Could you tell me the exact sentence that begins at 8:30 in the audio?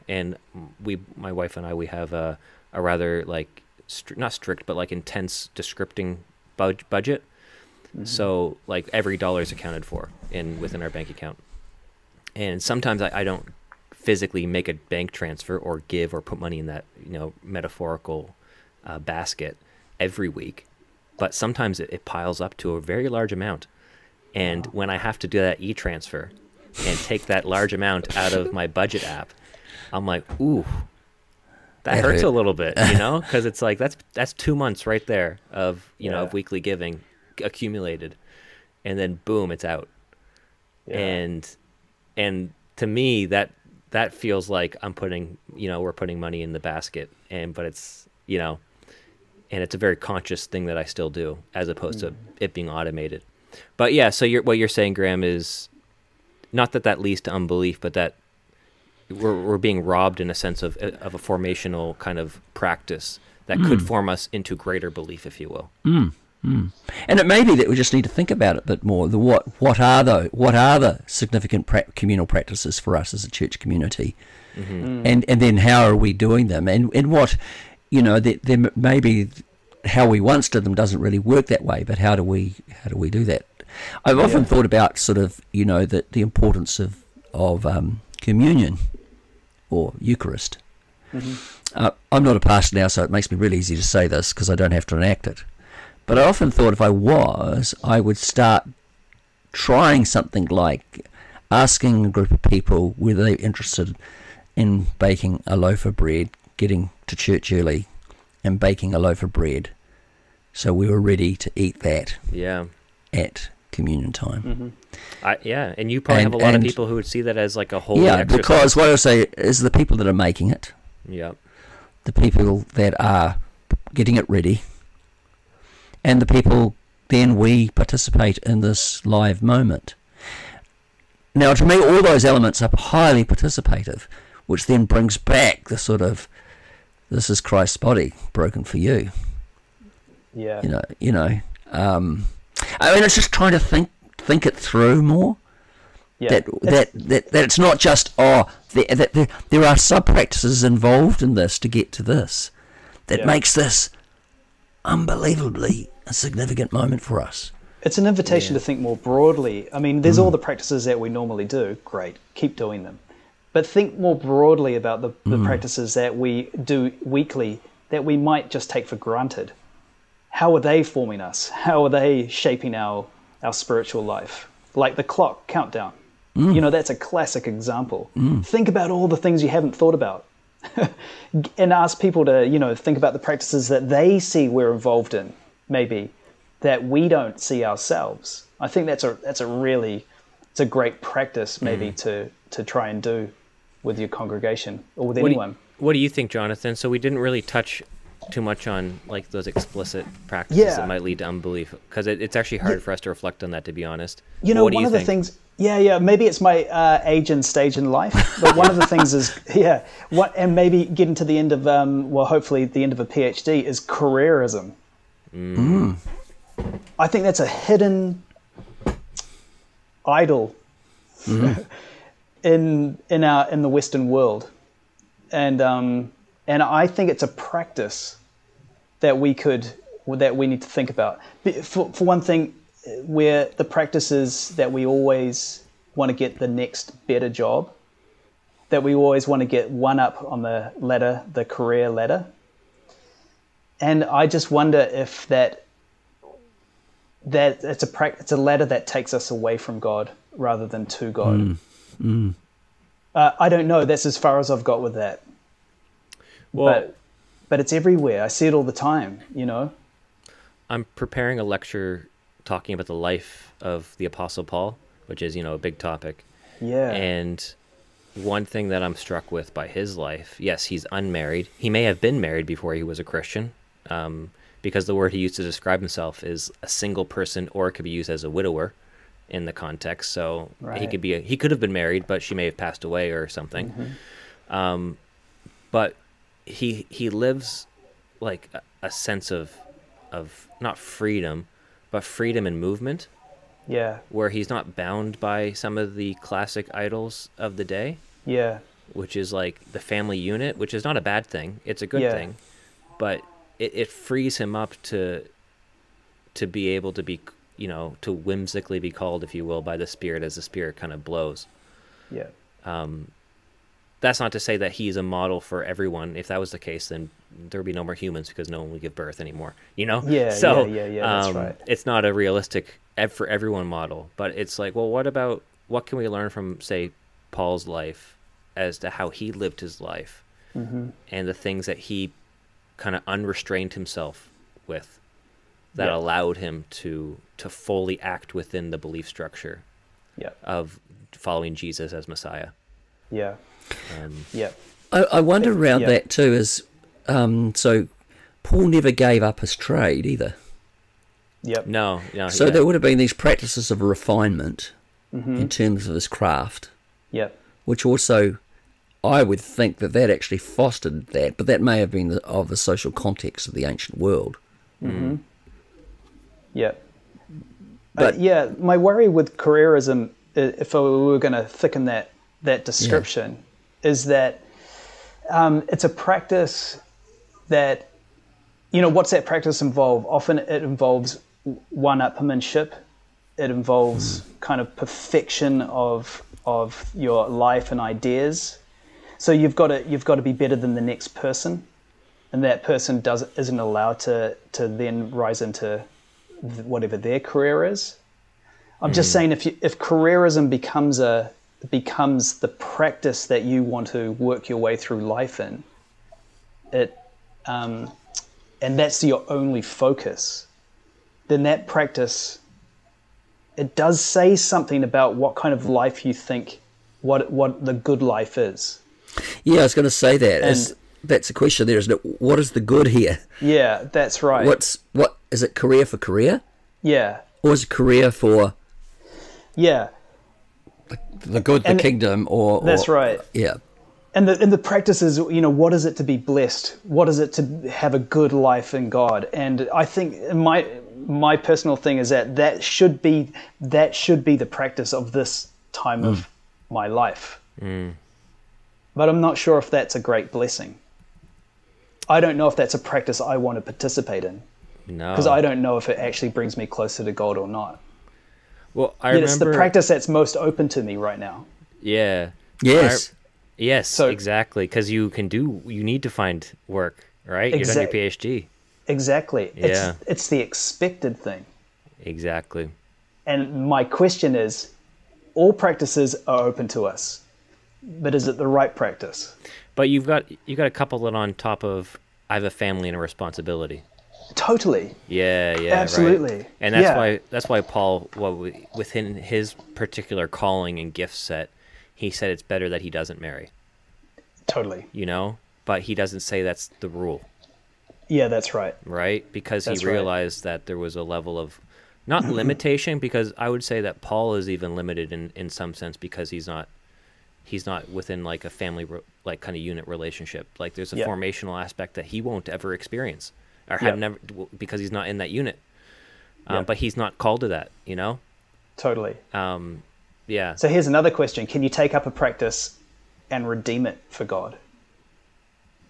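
Like there's a formational aspect that he won't ever experience or have yep.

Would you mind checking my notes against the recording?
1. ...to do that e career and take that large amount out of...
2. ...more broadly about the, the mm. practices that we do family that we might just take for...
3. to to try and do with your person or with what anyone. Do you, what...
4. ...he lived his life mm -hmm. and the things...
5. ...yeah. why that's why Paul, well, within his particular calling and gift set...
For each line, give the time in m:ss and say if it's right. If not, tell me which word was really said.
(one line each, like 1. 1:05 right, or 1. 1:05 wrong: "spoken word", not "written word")
1. 0:25 wrong: "transfer", not "career"
2. 2:43 wrong: "weekly", not "family"
3. 3:12 wrong: "congregation", not "person"
4. 5:29 right
5. 8:06 right.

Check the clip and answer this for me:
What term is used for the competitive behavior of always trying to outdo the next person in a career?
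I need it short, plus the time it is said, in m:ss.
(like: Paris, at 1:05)
One-upmanship, at 6:21.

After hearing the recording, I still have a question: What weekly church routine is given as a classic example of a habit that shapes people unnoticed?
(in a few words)
The clock countdown.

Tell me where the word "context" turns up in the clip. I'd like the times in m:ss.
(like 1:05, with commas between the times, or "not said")
4:39, 6:02.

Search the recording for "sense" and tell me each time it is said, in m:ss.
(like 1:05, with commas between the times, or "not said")
1:00, 4:48, 8:25.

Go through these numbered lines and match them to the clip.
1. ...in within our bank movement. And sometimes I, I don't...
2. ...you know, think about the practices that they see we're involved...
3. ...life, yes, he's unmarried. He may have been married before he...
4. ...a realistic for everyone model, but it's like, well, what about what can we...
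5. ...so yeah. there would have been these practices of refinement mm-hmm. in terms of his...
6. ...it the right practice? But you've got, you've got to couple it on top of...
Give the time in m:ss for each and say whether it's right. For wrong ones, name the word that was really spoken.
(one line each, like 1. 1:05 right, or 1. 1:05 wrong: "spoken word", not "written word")
1. 0:10 wrong: "account", not "movement"
2. 3:02 right
3. 4:29 right
4. 5:22 right
5. 5:52 right
6. 7:58 right.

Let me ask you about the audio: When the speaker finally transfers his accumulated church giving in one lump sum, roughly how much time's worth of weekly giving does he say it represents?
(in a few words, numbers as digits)
2 months.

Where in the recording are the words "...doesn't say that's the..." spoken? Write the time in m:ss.
8:15.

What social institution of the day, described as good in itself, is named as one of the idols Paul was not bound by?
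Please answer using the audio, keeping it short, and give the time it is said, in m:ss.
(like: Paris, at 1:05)
The family unit, at 4:59.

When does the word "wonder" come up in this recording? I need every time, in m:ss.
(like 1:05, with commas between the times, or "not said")
4:04, 5:45.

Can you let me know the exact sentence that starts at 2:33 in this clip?
makes this unbelievably a significant moment for us.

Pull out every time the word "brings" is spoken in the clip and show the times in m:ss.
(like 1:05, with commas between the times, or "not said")
2:14, 7:36.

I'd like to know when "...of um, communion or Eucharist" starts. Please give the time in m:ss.
1:27.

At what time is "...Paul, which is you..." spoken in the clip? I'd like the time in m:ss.
4:24.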